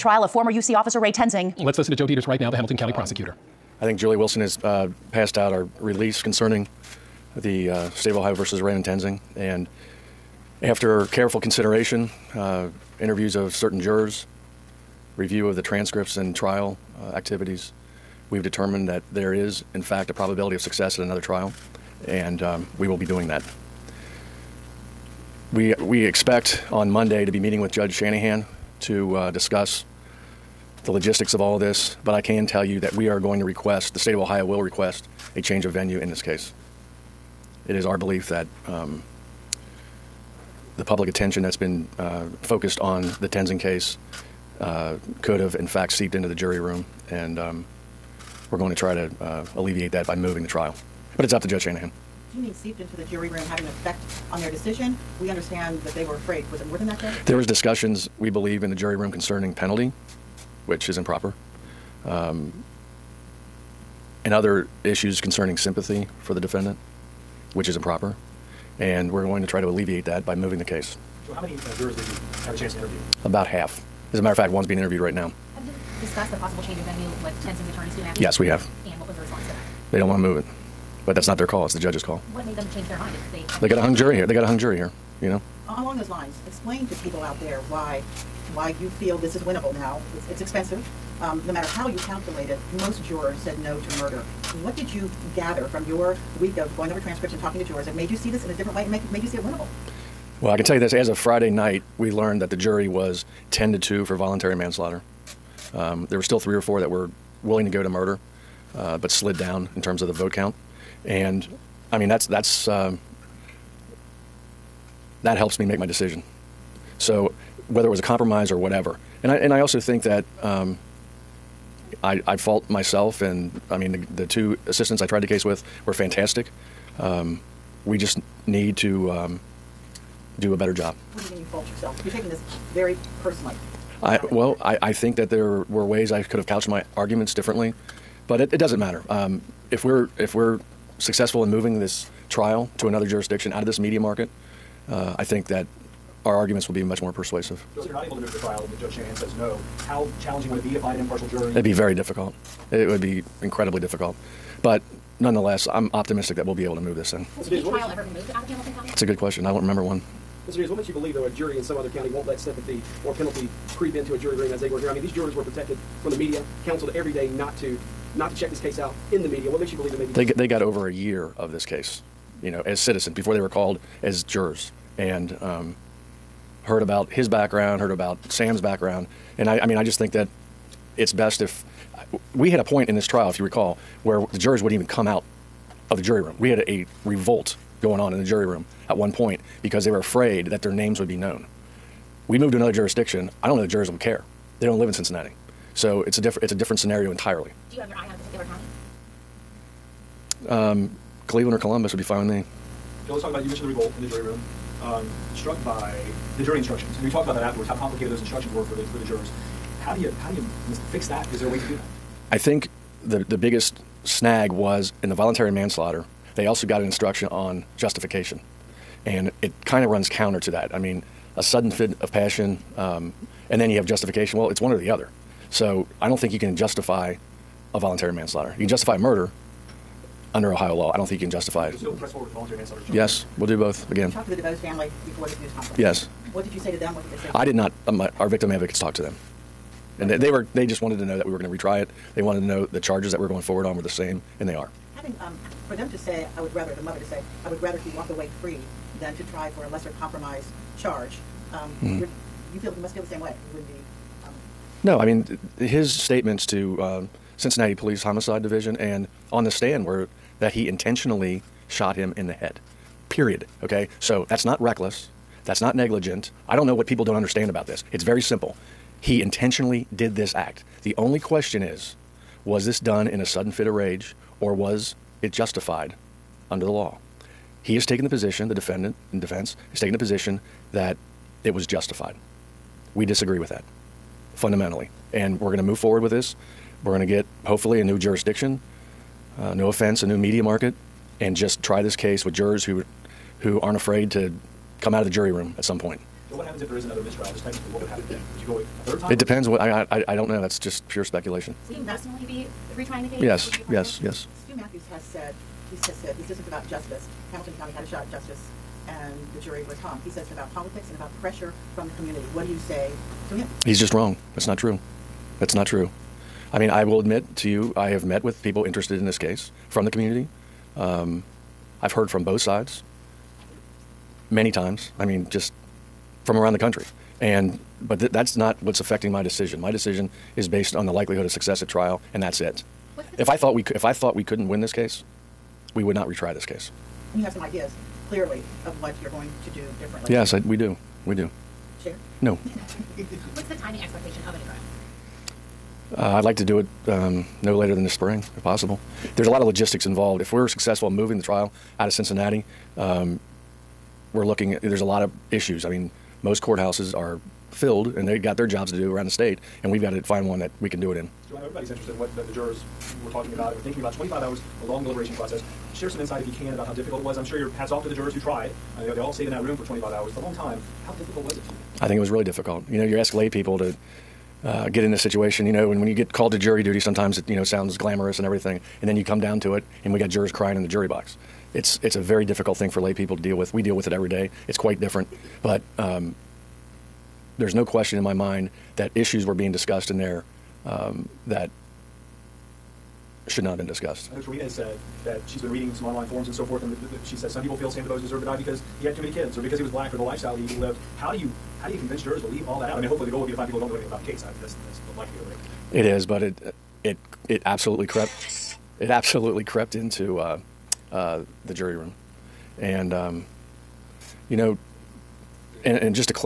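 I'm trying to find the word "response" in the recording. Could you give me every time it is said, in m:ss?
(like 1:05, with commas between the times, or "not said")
1:19.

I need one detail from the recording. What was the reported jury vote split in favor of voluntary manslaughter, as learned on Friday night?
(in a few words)
10 to 2.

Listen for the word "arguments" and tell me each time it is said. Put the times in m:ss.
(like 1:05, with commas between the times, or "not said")
2:16, 2:26.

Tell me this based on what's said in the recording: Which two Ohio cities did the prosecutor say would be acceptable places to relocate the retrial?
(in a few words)
Cleveland or Columbus.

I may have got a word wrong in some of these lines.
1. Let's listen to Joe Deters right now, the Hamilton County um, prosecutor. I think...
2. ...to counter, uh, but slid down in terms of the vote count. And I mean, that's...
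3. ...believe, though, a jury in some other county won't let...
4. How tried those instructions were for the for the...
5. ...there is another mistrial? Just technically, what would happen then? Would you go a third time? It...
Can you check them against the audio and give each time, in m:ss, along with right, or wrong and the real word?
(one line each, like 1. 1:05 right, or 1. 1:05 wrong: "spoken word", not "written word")
1. 0:01 right
2. 1:47 wrong: "murder", not "counter"
3. 2:40 right
4. 3:27 wrong: "complicated", not "tried"
5. 4:56 right.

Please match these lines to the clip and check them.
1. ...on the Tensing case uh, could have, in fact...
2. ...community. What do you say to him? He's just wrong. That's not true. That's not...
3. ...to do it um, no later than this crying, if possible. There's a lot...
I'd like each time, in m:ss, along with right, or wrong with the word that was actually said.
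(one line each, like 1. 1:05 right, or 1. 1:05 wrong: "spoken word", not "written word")
1. 0:42 right
2. 5:11 right
3. 5:46 wrong: "spring", not "crying".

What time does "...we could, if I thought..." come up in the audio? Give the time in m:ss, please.
5:33.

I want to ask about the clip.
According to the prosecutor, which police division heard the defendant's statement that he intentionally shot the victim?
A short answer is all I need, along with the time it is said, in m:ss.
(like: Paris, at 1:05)
Cincinnati Police Homicide Division, at 4:17.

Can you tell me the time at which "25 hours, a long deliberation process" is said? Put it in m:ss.
6:03.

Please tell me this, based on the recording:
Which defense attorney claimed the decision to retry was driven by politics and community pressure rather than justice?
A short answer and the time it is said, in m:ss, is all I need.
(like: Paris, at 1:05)
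Stew Mathews, at 5:04.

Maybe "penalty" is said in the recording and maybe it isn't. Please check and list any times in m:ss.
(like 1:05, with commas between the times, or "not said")
0:59, 2:43.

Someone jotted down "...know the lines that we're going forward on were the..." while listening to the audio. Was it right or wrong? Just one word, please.
wrong.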